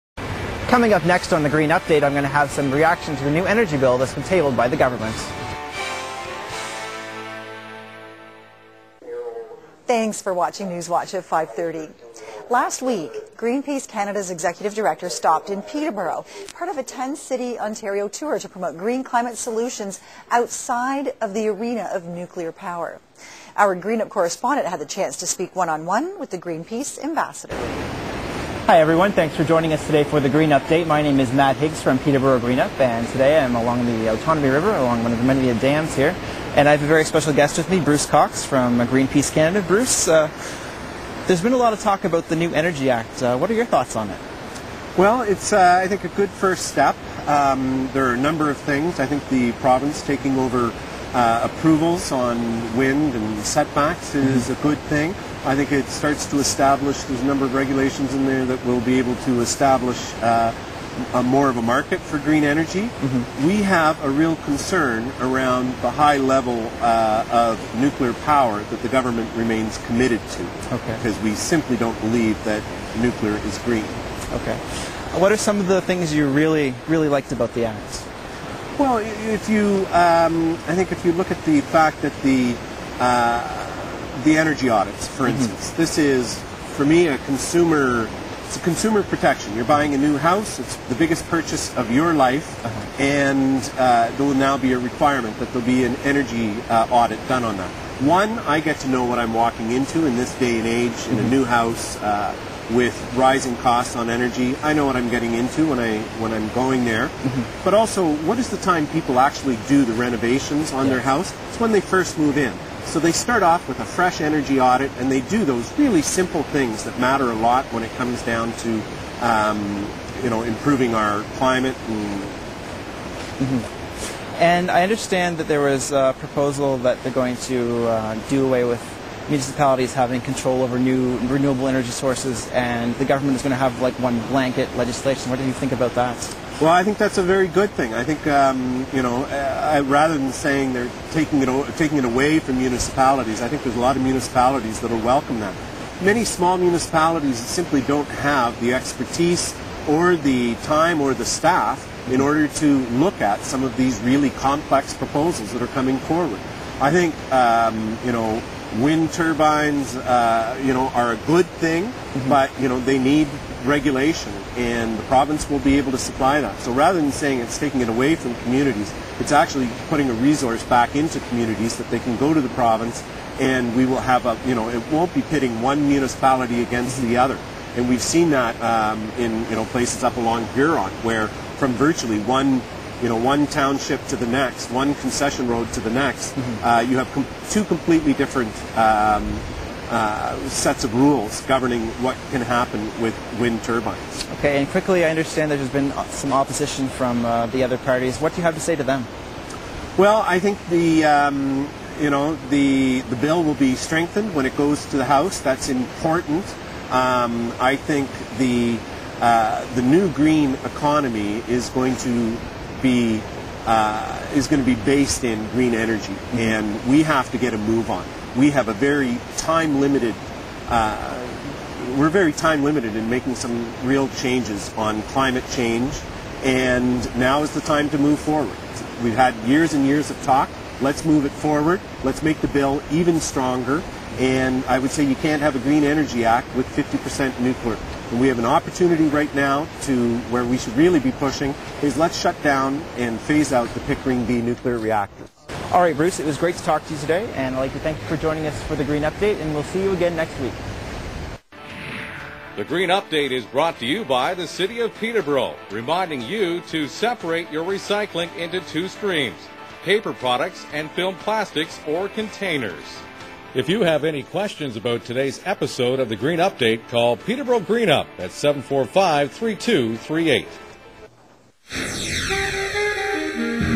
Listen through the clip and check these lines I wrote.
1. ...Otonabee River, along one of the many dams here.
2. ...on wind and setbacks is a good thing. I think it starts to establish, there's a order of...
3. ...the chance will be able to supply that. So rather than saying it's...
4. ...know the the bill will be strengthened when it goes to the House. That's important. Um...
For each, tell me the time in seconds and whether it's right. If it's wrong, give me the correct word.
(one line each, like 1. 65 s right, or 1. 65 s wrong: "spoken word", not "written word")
1. 34 s right
2. 52 s wrong: "number", not "order"
3. 164 s wrong: "province", not "chance"
4. 202 s right.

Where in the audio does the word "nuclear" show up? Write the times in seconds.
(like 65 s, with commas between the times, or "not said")
22 s, 67 s, 73 s, 237 s, 244 s.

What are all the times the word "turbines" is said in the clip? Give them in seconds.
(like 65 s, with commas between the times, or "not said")
159 s, 193 s.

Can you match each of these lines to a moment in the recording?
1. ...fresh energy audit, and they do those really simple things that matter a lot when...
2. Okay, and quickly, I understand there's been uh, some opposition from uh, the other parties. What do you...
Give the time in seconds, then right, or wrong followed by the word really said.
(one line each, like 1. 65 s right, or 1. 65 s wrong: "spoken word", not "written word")
1. 113 s right
2. 194 s right.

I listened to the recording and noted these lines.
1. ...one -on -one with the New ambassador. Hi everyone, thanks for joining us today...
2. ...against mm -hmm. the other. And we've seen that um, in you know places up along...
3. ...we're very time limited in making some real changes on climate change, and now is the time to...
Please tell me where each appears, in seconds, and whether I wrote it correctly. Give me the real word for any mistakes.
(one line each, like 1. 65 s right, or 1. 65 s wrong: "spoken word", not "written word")
1. 25 s wrong: "Greenpeace", not "New"
2. 176 s right
3. 221 s right.